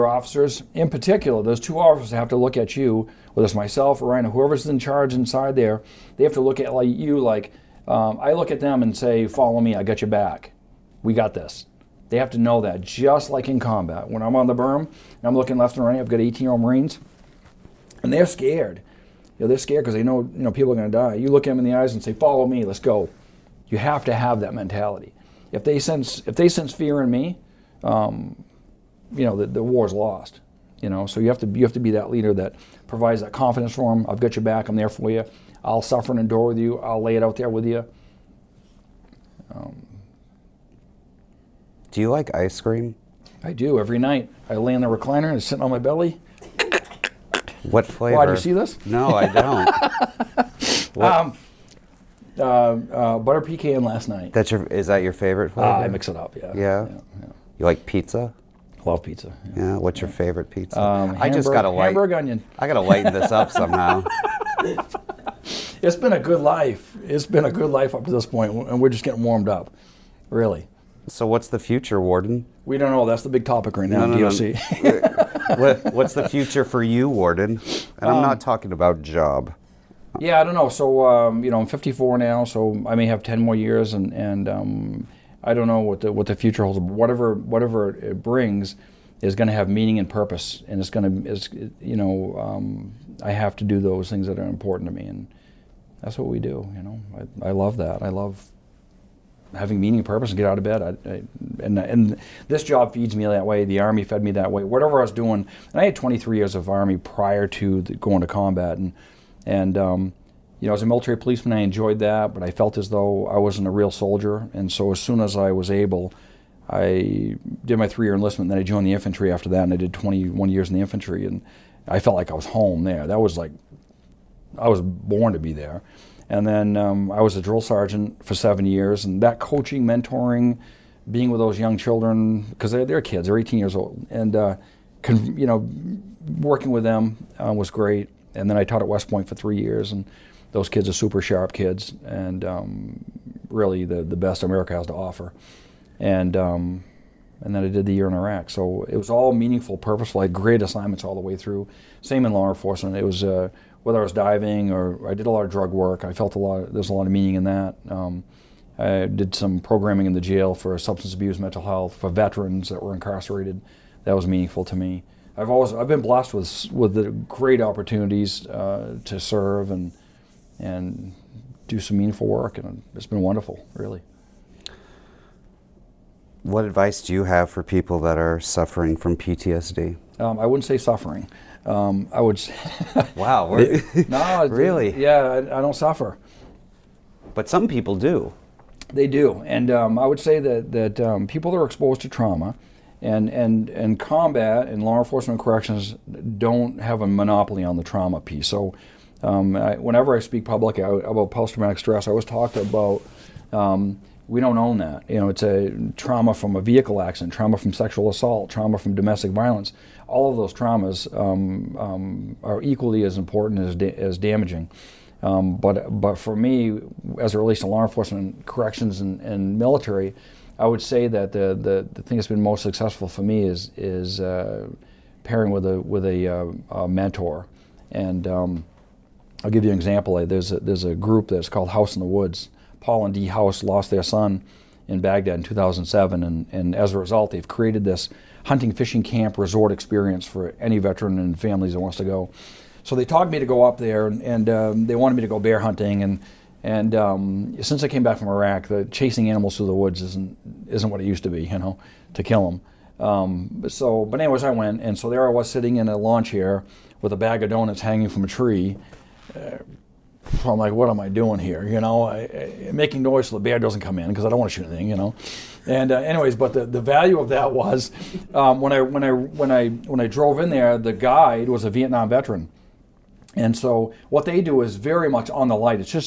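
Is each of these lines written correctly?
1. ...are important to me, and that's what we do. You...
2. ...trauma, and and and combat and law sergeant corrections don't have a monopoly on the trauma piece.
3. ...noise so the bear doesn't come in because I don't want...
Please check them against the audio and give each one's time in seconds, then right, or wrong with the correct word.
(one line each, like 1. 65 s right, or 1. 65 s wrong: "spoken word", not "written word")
1. 94 s right
2. 192 s wrong: "enforcement", not "sergeant"
3. 263 s right.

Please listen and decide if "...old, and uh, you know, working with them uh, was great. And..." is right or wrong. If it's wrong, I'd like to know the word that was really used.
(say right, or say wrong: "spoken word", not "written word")
right.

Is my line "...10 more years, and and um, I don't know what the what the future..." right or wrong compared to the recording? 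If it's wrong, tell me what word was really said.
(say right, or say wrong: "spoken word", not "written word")
right.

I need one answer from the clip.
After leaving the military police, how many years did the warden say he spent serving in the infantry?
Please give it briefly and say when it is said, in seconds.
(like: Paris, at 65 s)
21, at 119 s.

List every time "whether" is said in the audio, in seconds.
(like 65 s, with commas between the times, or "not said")
3 s, 153 s.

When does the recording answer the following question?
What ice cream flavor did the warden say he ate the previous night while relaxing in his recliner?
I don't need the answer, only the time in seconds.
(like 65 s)
53 s.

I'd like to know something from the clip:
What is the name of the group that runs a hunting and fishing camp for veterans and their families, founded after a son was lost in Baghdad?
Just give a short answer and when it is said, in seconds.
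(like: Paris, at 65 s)
House in the Woods, at 231 s.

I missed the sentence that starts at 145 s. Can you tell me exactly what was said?
And um, and then I did the year in Iraq, so it was all meaningful, purposeful.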